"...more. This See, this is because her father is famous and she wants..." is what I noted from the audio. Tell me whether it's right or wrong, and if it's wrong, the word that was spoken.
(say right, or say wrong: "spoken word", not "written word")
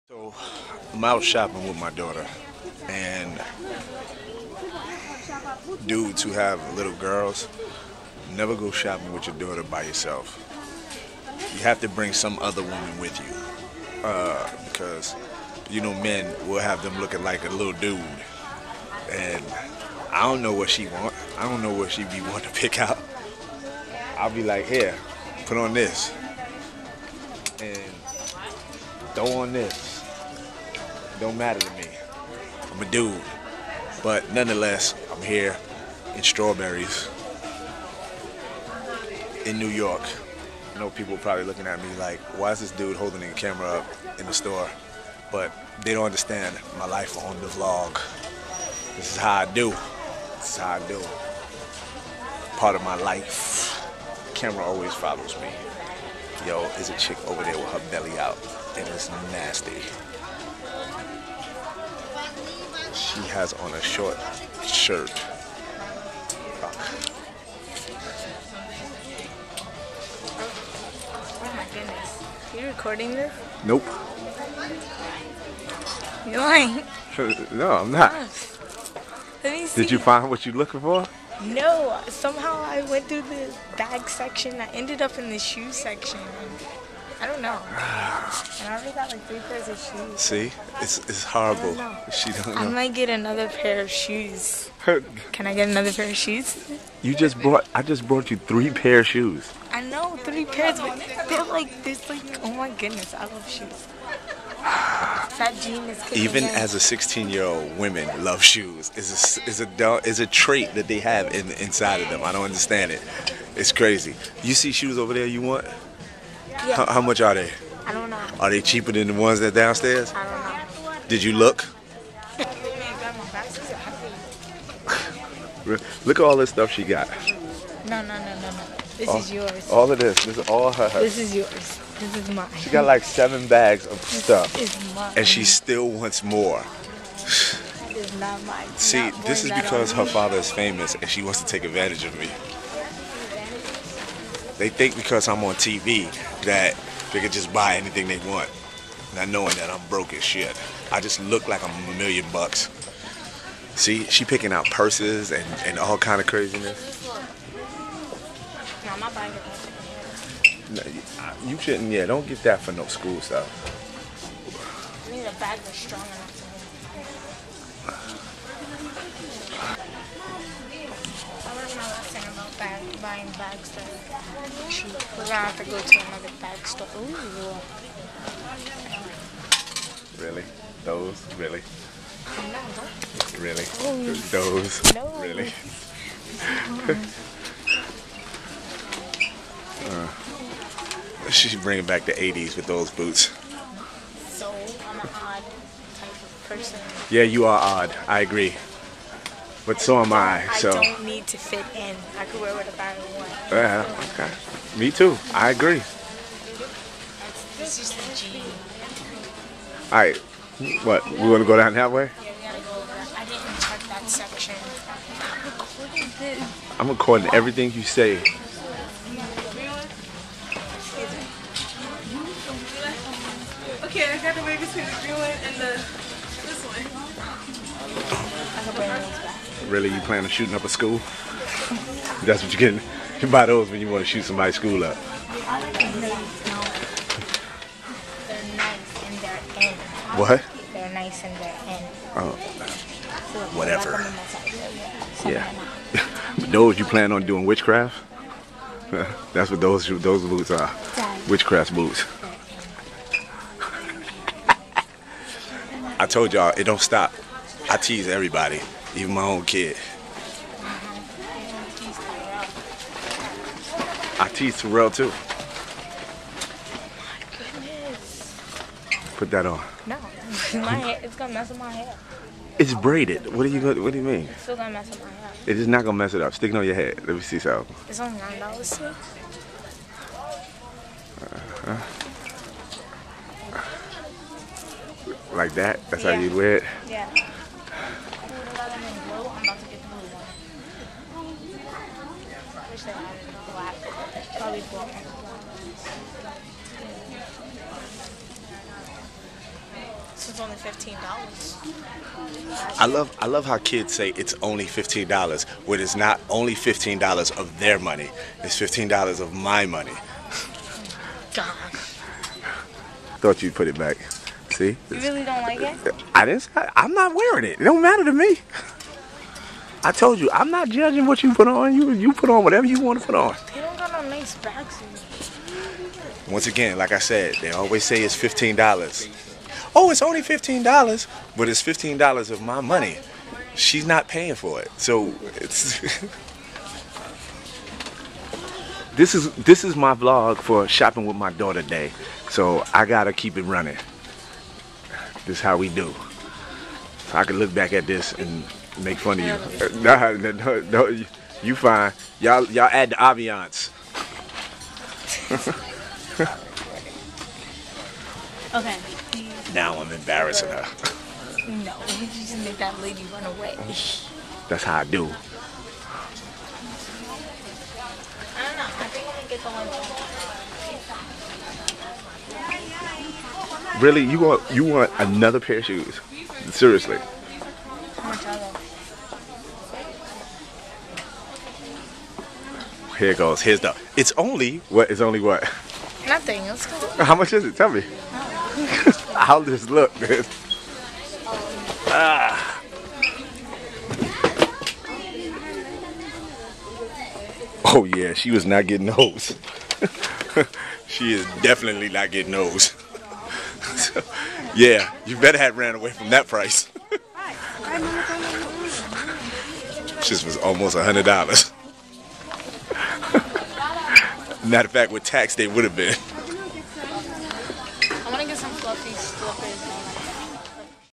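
right.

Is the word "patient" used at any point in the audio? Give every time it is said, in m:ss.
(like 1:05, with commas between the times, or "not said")
not said.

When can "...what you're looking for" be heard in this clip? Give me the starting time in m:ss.
1:20.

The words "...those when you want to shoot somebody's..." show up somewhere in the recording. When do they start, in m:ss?
3:53.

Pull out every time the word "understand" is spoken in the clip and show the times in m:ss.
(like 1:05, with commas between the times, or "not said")
0:46, 1:52.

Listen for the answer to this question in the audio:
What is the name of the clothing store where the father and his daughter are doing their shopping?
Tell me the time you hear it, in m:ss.
0:36.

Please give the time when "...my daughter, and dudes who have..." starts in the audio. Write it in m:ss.
0:01.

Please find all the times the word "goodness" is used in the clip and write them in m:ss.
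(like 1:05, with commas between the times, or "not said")
1:11, 1:42, 4:27.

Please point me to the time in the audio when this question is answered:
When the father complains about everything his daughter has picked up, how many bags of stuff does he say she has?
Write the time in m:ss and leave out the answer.
2:13.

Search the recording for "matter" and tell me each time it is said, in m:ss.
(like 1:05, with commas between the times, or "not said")
0:31, 5:17, 6:54.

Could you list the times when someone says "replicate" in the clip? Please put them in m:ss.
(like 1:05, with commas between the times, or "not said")
not said.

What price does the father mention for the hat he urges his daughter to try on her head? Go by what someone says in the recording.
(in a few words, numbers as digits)
$9.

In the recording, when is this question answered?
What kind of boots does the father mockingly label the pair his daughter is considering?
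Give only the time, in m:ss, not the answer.
4:11.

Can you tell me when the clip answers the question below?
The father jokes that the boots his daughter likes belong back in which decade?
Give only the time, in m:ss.
3:12.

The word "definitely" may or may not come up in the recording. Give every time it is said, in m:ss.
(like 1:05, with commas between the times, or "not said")
6:41.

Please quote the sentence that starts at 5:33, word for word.
She's not paying for it, so it's.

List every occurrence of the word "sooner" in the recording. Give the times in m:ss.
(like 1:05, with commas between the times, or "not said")
not said.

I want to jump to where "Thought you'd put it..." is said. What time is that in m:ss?
5:13.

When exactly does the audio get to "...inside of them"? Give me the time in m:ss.
1:51.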